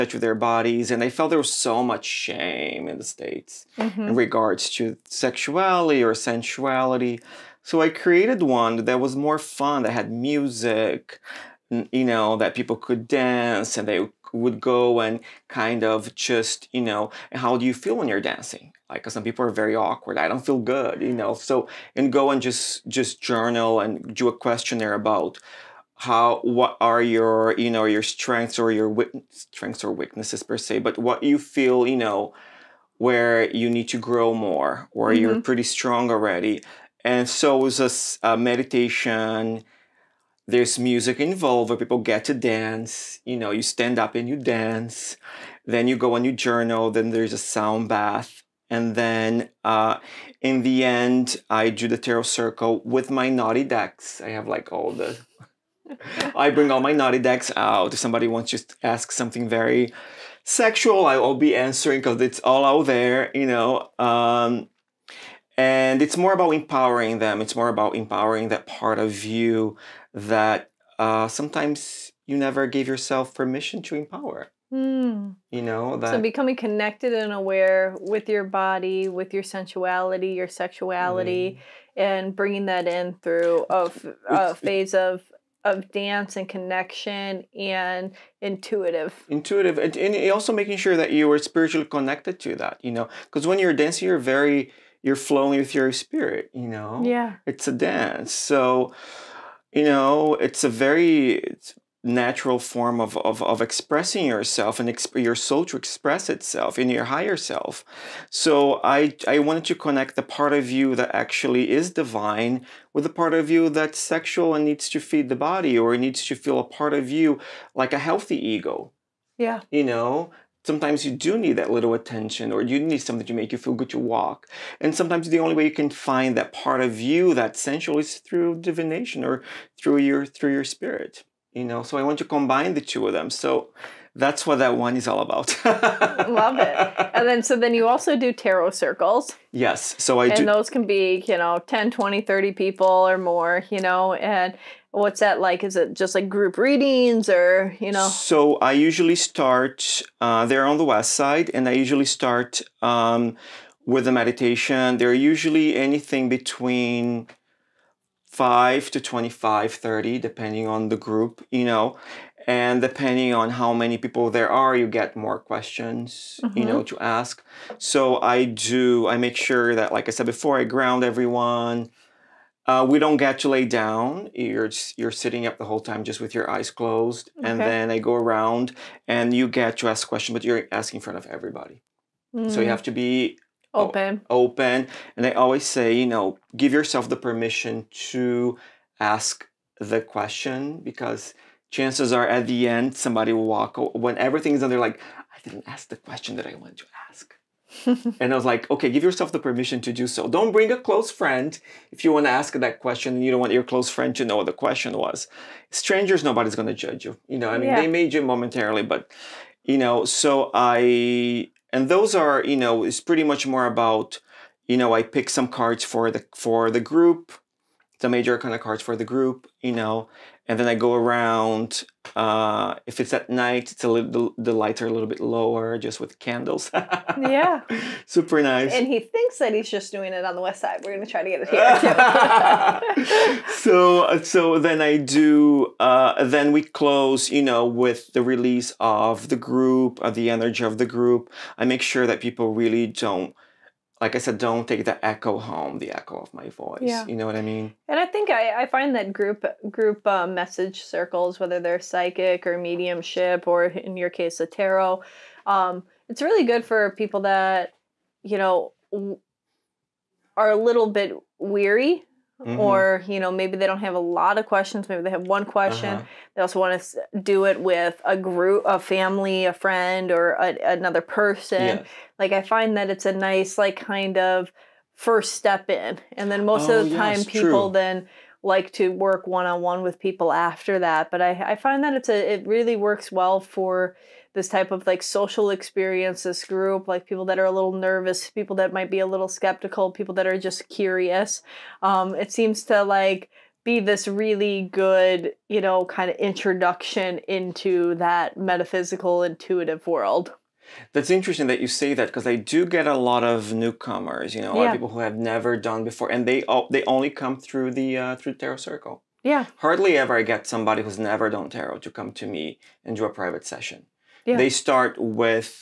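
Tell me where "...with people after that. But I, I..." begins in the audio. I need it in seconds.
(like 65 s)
279 s.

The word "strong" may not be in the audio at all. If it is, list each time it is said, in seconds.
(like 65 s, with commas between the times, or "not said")
35 s.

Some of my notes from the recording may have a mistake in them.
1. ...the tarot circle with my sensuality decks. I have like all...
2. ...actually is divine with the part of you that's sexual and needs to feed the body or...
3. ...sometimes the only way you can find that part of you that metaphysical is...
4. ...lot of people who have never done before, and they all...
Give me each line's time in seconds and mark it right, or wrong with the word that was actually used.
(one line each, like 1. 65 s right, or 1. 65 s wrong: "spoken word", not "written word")
1. 51 s wrong: "naughty", not "sensuality"
2. 111 s right
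3. 124 s wrong: "sensual", not "metaphysical"
4. 304 s right.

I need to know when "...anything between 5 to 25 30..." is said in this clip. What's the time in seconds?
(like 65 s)
155 s.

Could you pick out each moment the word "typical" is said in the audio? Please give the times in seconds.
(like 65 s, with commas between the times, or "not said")
not said.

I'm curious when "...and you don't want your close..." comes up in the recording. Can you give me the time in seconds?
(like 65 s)
203 s.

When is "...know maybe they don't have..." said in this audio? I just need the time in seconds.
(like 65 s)
263 s.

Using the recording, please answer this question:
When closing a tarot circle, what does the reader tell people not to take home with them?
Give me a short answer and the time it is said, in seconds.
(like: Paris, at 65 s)
the echo of my voice, at 245 s.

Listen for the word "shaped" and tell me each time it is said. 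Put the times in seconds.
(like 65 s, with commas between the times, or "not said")
not said.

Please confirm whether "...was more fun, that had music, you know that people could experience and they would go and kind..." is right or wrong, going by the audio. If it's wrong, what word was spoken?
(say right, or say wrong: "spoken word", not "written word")
wrong: "dance", not "experience".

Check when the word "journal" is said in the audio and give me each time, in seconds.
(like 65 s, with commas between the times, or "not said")
23 s, 46 s.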